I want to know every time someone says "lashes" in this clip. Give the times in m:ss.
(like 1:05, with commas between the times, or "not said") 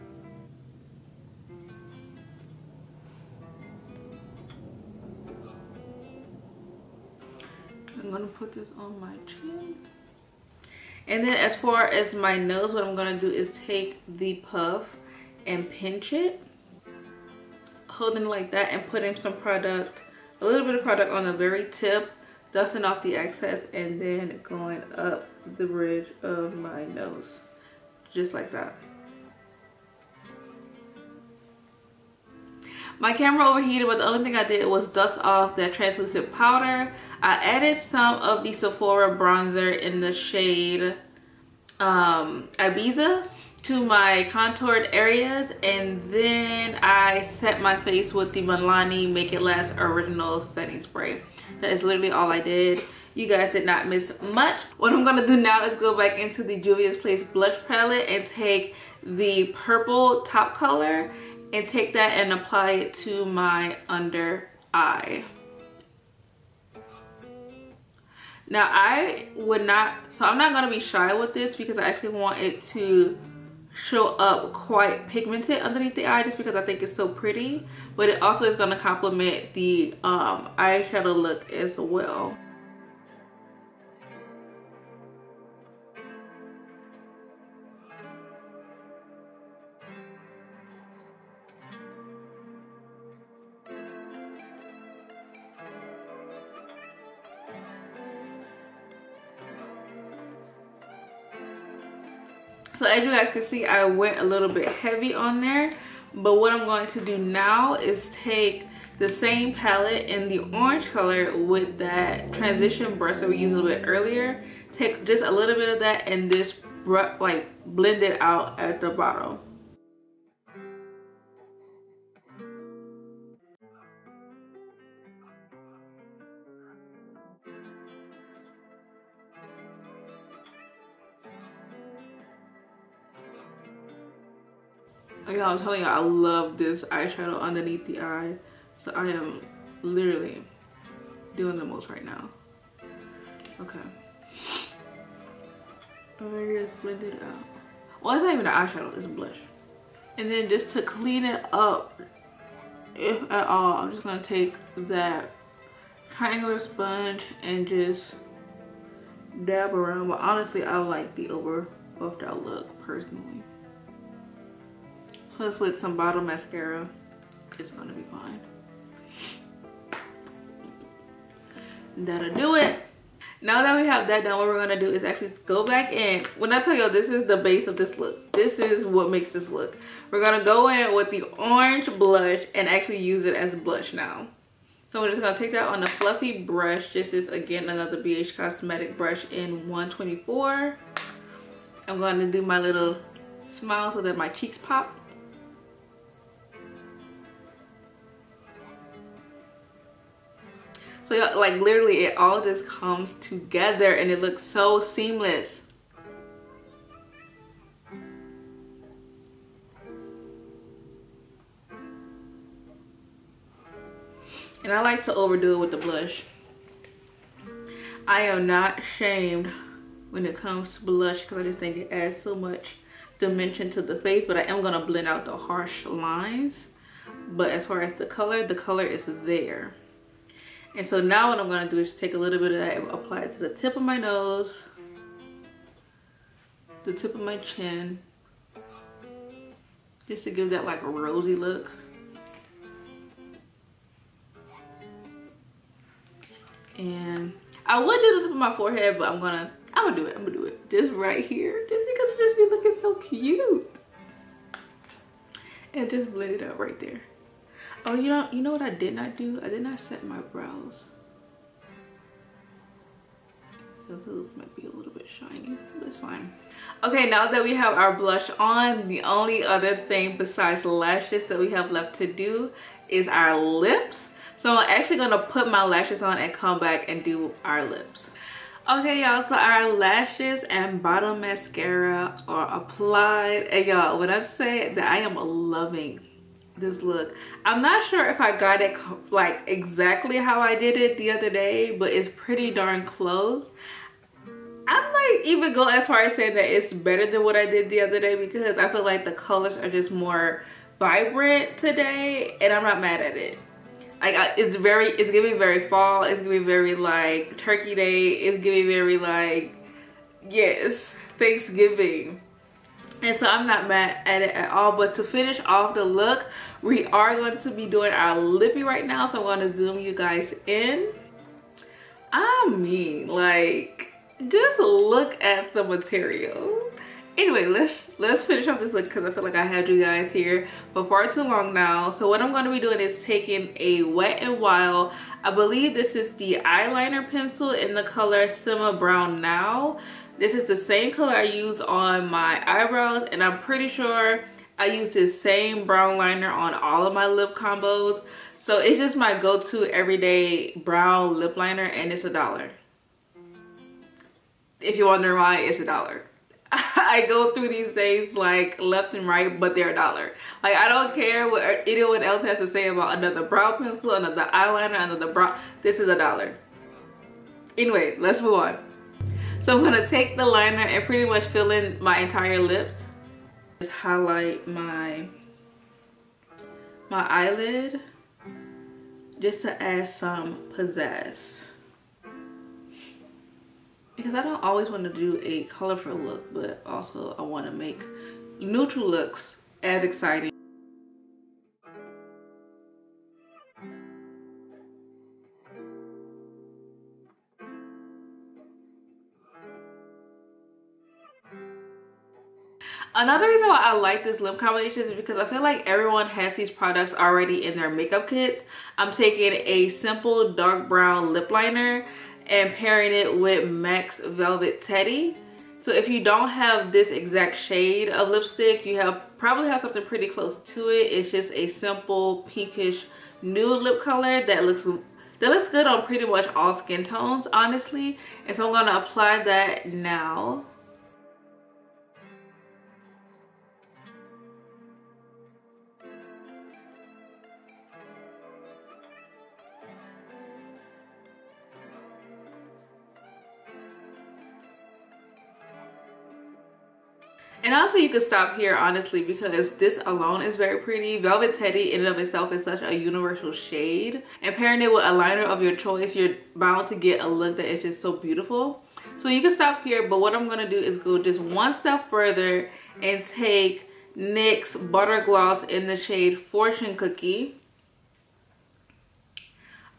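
4:30, 4:35, 4:39.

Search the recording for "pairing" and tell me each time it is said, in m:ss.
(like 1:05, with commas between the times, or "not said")
6:52, 7:34.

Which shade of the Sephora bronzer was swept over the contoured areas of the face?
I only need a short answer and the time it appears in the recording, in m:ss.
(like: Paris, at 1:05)
Ibiza, at 0:42.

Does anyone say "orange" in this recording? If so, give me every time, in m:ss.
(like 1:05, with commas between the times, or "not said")
1:50, 3:01.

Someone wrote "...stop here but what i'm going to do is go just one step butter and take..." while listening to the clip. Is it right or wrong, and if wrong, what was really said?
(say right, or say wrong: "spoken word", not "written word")
wrong: "further", not "butter".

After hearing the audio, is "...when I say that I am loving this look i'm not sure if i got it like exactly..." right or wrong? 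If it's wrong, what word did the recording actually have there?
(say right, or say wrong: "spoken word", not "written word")
right.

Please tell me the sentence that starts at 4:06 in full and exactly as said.
And I would do this with my forehead, but I'm gonna, I'm gonna do it, I'm gonna do it.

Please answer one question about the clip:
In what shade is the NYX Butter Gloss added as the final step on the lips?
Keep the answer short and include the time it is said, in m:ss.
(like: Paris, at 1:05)
Fortune Cookie, at 7:46.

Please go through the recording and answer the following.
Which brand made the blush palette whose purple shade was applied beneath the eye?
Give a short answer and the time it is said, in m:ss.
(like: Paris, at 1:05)
Juvia's Place, at 0:56.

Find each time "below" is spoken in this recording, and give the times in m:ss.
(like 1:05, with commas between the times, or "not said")
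not said.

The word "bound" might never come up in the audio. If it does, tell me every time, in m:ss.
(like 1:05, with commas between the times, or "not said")
7:36.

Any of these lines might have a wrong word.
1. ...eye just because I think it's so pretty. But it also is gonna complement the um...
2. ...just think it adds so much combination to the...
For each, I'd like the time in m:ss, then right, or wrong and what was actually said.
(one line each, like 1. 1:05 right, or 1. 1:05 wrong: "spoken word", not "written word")
1. 1:16 right
2. 3:41 wrong: "dimension", not "combination".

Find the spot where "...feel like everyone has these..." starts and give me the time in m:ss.
6:45.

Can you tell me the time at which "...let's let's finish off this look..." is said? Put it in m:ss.
5:27.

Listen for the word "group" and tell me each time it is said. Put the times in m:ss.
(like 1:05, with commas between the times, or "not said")
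not said.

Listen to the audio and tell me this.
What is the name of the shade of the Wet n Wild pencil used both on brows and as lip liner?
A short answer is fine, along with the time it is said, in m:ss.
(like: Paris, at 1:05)
Simma Brown, at 5:38.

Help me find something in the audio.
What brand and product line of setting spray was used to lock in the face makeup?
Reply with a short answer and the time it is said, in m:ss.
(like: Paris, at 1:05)
Milani Make It Last, at 0:48.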